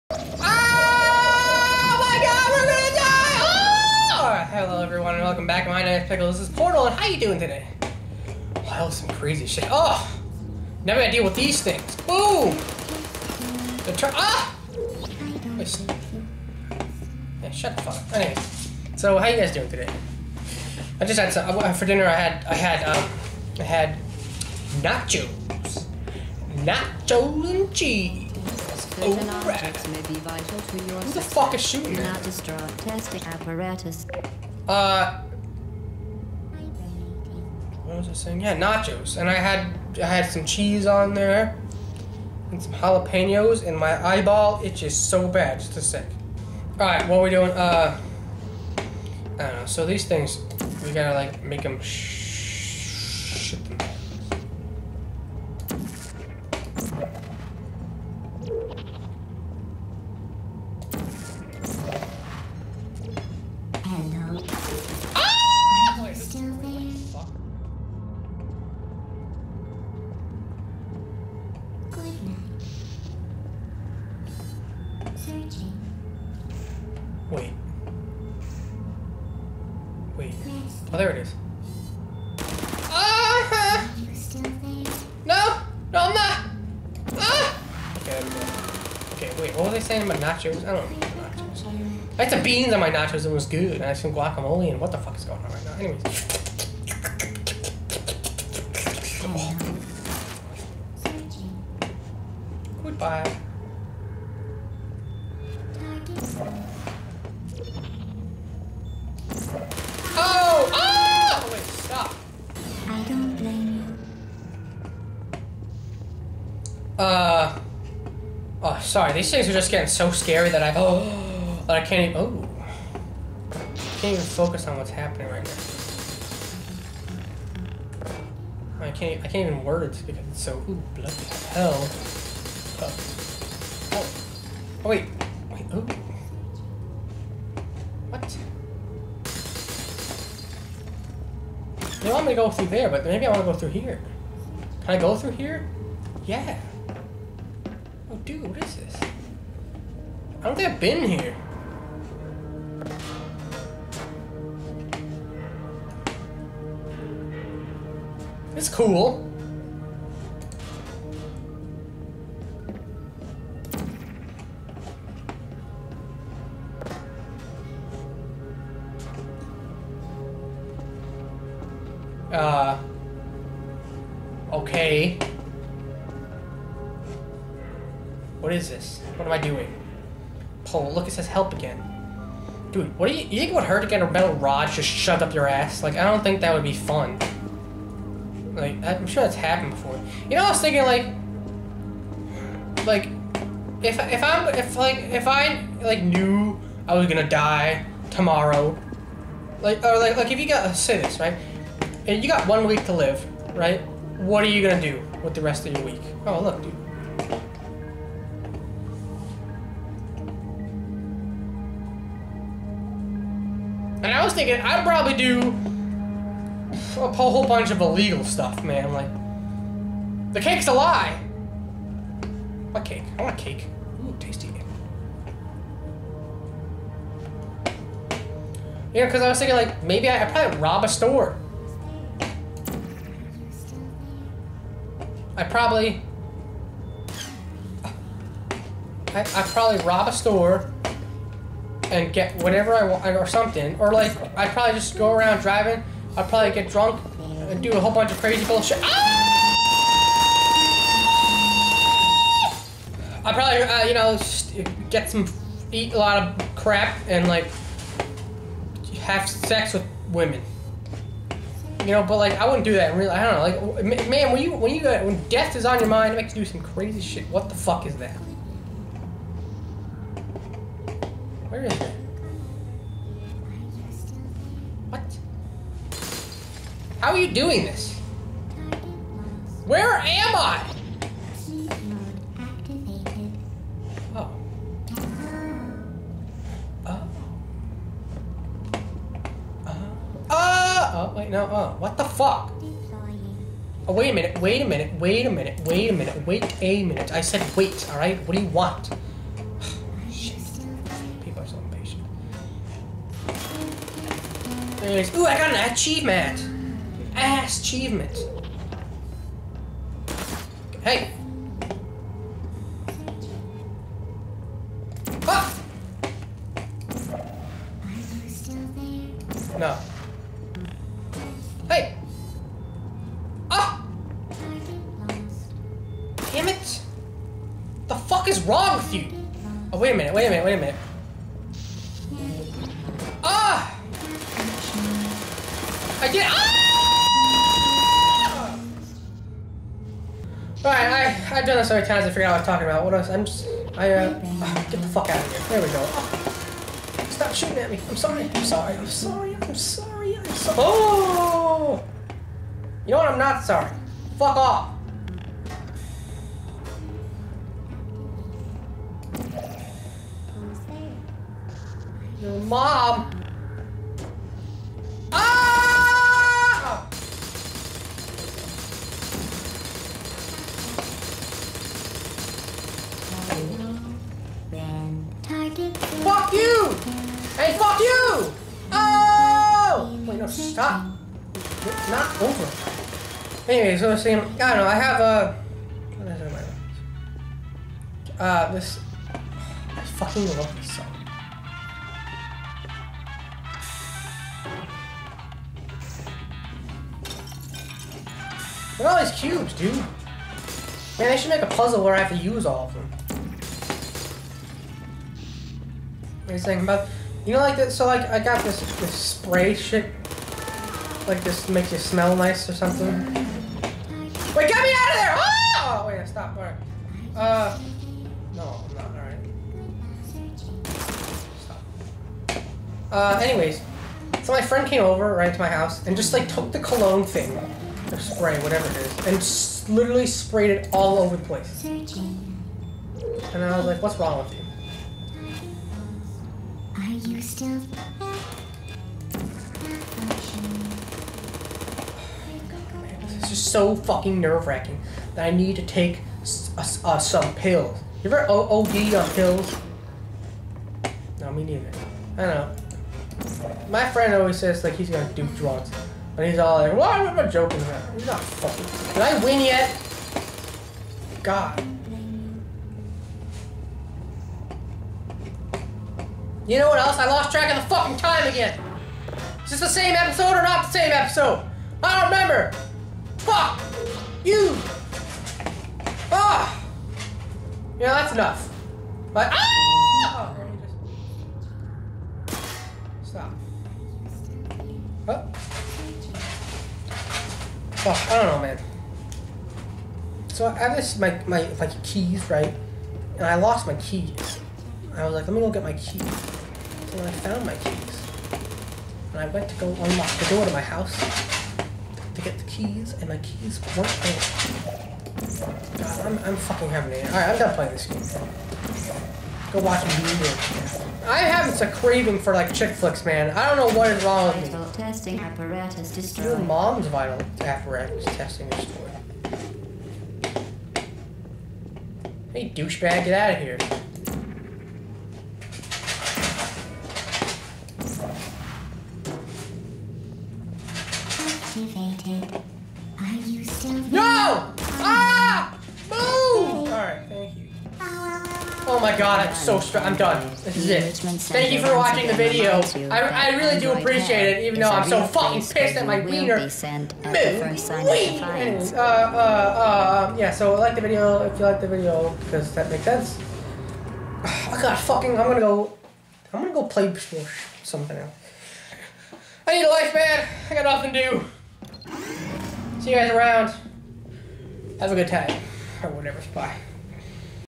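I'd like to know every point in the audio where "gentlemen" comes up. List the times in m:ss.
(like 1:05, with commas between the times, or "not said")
not said.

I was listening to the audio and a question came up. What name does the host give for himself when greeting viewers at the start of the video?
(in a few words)
Pickle.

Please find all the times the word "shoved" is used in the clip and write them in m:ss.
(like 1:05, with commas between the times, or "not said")
3:04.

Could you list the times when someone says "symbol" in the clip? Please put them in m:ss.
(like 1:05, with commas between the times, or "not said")
not said.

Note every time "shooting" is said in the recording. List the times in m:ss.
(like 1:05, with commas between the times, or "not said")
0:31, 5:47.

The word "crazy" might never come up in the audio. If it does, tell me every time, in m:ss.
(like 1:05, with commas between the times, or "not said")
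0:09, 4:08, 4:26.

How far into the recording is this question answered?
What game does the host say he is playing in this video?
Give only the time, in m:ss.
0:06.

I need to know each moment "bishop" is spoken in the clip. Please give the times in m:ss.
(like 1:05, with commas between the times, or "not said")
not said.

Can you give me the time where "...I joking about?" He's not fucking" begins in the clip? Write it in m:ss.
7:37.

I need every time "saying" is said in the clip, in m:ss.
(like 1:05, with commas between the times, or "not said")
0:38, 1:29, 6:24, 6:46.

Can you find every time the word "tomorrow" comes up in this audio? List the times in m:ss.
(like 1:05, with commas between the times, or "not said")
3:18.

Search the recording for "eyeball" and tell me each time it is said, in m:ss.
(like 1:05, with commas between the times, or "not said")
0:44.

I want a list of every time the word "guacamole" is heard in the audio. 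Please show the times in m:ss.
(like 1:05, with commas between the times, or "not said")
1:34.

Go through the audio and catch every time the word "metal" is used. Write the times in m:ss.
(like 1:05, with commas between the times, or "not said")
3:04.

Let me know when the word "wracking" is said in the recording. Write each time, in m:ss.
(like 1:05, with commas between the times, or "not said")
7:24.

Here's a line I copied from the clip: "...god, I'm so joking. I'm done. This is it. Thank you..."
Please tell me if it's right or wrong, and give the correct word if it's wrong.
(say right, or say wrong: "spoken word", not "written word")
wrong: "strong", not "joking".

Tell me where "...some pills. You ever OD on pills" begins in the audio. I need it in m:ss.
7:26.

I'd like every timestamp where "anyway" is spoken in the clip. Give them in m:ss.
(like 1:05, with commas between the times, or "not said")
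0:18, 1:35, 6:23, 7:03, 9:06.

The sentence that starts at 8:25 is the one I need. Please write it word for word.
God, I'm, I'm fucking having it.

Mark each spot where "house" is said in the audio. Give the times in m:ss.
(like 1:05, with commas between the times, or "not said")
7:05, 8:20.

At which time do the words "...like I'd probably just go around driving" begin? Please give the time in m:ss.
4:03.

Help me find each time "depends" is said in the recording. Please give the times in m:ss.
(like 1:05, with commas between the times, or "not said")
not said.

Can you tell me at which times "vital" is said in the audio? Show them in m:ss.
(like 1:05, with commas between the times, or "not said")
8:36.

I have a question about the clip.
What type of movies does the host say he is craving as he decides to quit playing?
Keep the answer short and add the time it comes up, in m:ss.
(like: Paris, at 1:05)
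chick flicks, at 8:32.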